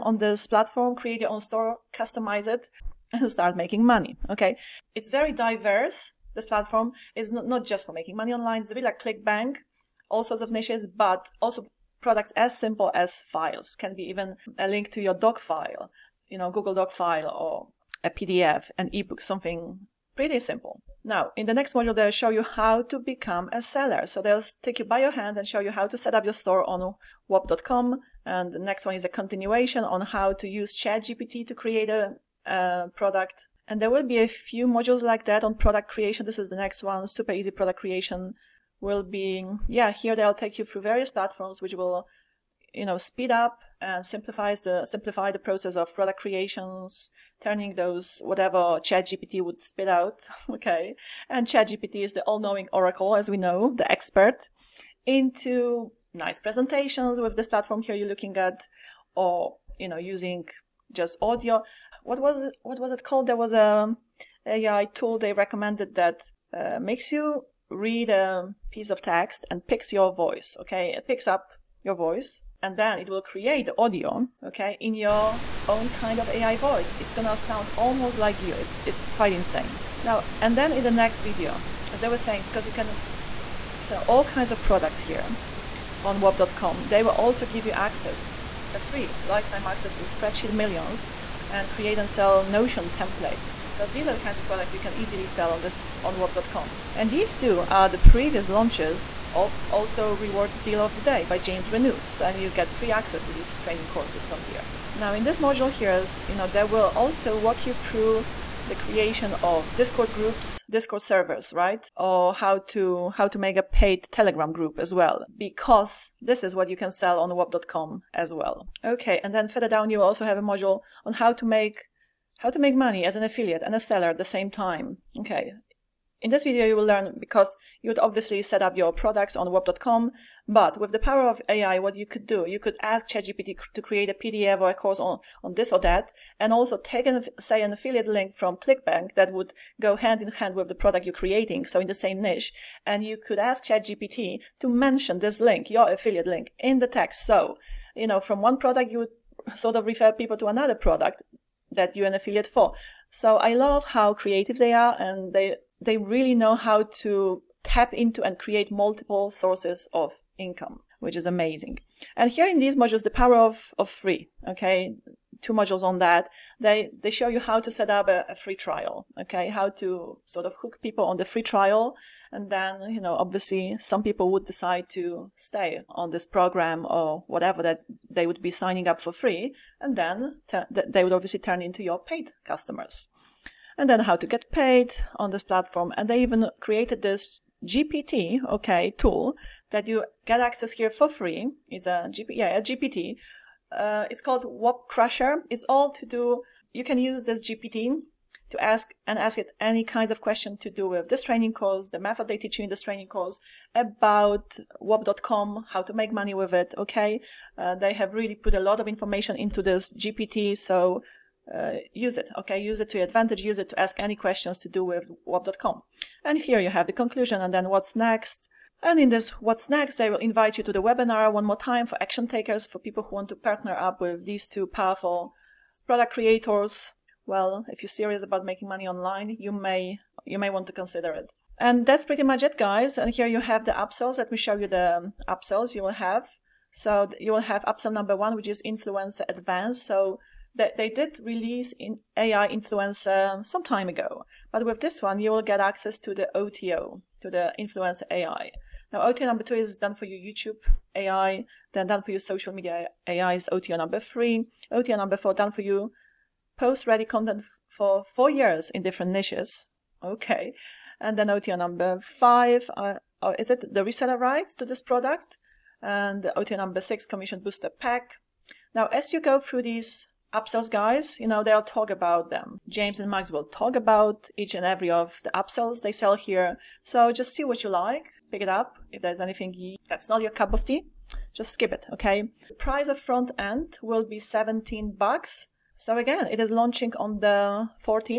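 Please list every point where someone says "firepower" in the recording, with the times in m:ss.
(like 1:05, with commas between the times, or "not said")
not said.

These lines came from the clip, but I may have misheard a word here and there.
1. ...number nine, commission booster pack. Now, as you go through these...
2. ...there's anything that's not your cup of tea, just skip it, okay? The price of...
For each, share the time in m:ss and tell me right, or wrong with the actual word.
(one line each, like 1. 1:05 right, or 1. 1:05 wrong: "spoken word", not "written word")
1. 4:26 wrong: "six", not "nine"
2. 4:39 right.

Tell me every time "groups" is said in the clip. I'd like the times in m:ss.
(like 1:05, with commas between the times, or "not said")
1:50, 1:54.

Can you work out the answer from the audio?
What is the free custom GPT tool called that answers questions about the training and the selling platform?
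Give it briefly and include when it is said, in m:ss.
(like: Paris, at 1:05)
Whop Crusher, at 3:14.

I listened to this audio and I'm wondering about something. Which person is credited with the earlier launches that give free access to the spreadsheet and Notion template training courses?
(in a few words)
James Renouf.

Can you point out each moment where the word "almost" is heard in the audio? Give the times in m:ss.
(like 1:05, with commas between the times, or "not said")
1:17.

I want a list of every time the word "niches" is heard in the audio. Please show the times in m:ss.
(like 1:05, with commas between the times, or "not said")
0:10, 2:22, 4:19.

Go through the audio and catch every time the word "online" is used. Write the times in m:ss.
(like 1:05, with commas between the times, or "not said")
0:08, 3:48.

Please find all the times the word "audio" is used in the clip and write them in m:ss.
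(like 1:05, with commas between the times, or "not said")
1:01, 1:13.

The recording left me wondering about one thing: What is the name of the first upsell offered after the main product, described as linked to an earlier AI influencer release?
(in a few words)
Influencer Advanced.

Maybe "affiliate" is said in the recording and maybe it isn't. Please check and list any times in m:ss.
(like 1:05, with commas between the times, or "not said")
2:03, 2:17, 2:25, 2:32.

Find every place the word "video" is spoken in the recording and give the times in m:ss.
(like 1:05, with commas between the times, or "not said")
1:21, 2:06.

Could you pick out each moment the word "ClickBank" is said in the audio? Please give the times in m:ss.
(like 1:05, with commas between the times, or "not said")
0:09, 2:18.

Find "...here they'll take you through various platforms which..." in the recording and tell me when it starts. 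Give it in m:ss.
0:39.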